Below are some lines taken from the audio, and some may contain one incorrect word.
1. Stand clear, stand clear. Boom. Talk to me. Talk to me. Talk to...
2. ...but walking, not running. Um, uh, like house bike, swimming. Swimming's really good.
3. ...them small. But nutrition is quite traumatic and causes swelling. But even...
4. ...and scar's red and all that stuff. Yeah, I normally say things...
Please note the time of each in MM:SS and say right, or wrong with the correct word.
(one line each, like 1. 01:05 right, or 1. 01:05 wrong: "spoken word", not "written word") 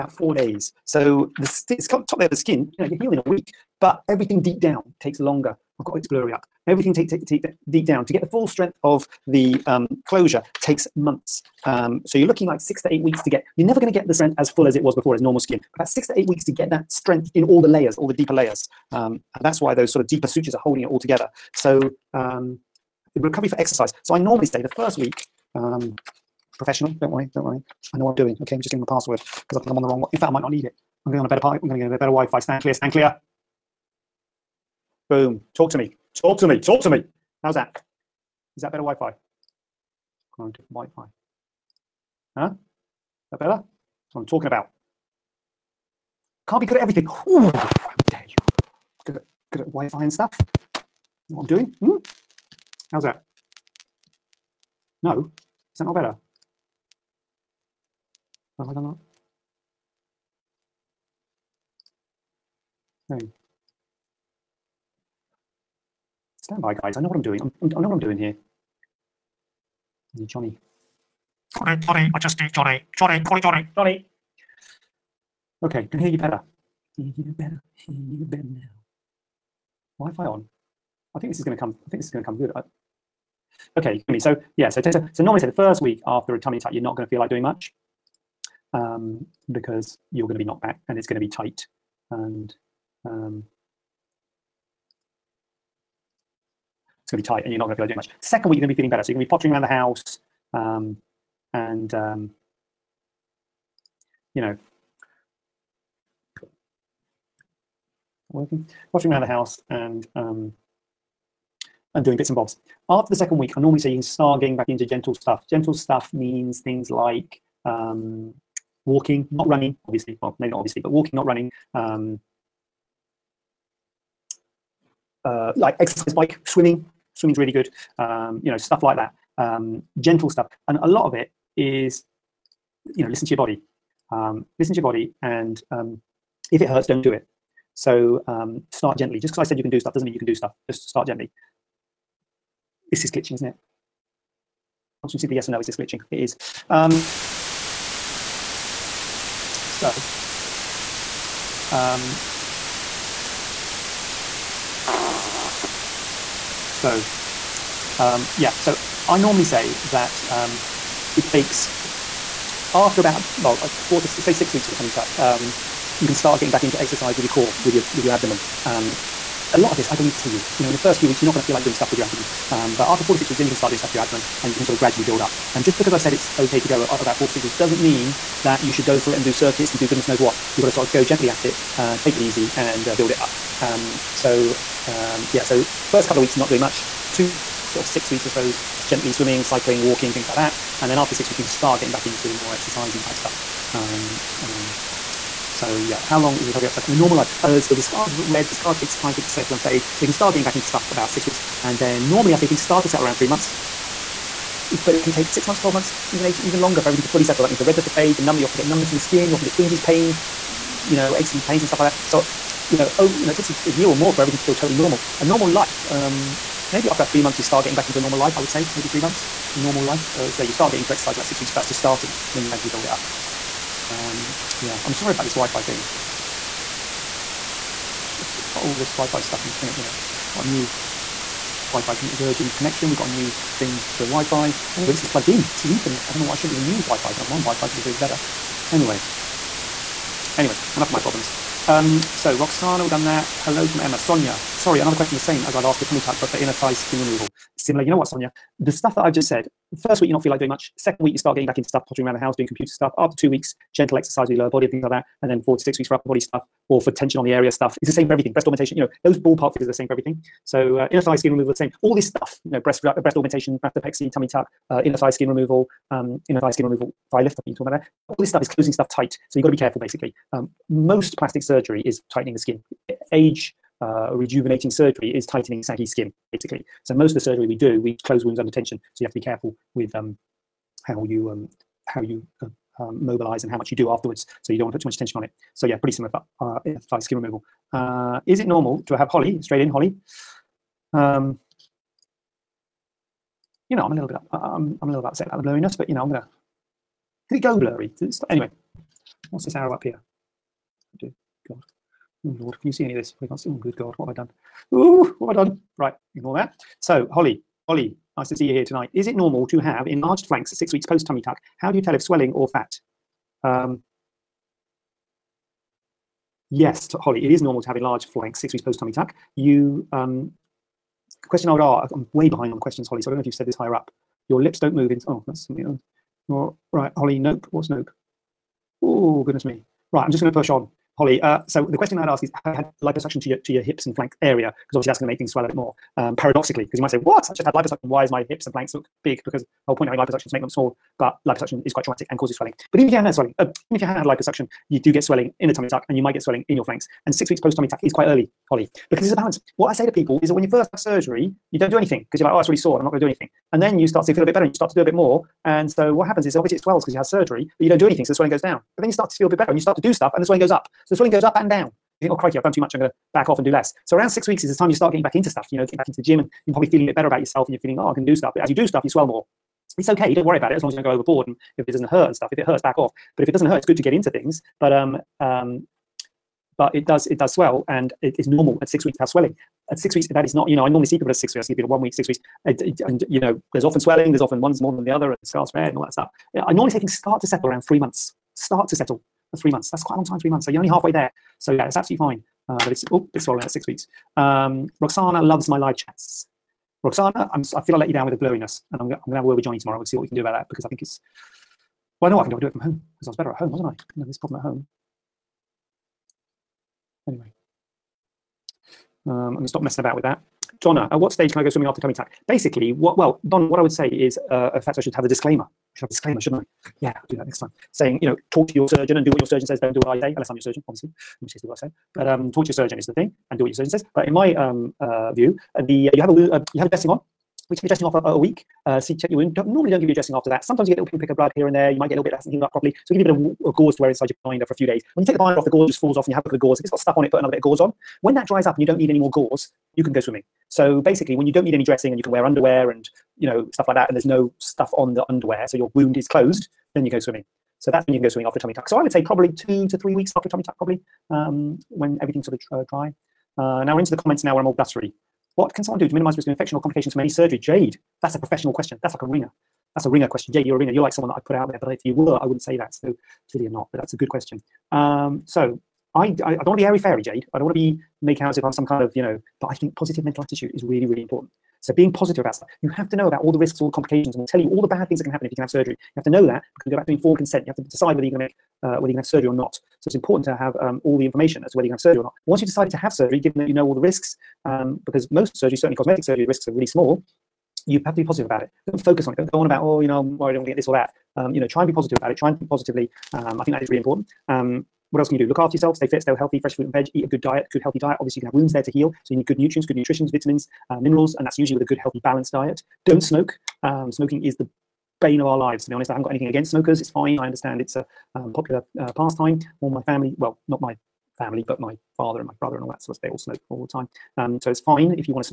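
1. 00:32 right
2. 02:00 wrong: "exercise", not "house"
3. 05:40 wrong: "liposuction", not "nutrition"
4. 06:25 right.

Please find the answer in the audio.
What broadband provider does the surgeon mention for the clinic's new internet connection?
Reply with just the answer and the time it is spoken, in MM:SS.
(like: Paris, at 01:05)
Virgin, at 03:52.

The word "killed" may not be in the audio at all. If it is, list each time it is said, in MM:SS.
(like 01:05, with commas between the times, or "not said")
not said.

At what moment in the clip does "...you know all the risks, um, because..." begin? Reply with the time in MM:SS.
08:03.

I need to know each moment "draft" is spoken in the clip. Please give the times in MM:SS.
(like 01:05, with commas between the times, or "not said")
not said.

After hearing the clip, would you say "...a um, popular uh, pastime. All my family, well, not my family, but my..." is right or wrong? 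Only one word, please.
right.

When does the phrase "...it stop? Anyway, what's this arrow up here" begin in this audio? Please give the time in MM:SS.
04:58.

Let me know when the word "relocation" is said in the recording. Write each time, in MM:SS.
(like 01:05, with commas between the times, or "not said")
not said.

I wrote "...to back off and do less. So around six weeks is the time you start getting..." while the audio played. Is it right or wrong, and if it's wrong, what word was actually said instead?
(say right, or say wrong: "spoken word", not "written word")
right.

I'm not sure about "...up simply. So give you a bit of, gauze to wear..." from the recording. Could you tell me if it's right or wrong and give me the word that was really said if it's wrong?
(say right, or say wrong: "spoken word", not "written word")
wrong: "properly", not "simply".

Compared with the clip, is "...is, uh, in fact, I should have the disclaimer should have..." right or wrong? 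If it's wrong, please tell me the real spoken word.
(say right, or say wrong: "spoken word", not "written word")
right.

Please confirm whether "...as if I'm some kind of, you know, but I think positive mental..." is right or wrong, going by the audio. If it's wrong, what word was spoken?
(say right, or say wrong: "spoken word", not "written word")
right.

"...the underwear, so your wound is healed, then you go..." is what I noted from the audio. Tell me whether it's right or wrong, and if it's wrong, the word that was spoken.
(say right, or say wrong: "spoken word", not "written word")
wrong: "closed", not "healed".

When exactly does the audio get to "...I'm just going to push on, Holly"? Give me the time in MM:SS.
05:30.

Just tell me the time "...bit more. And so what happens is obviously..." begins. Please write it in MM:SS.
05:54.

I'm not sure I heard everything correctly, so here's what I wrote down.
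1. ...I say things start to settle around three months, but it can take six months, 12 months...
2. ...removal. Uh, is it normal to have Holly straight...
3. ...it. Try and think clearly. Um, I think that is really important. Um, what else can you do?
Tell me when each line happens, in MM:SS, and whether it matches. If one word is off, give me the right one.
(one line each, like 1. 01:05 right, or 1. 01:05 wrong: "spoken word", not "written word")
1. 03:22 right
2. 04:47 right
3. 08:12 wrong: "positively", not "clearly".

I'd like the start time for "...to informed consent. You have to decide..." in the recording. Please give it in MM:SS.
07:56.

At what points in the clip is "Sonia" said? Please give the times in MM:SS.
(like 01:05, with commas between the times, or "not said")
04:03, 04:08.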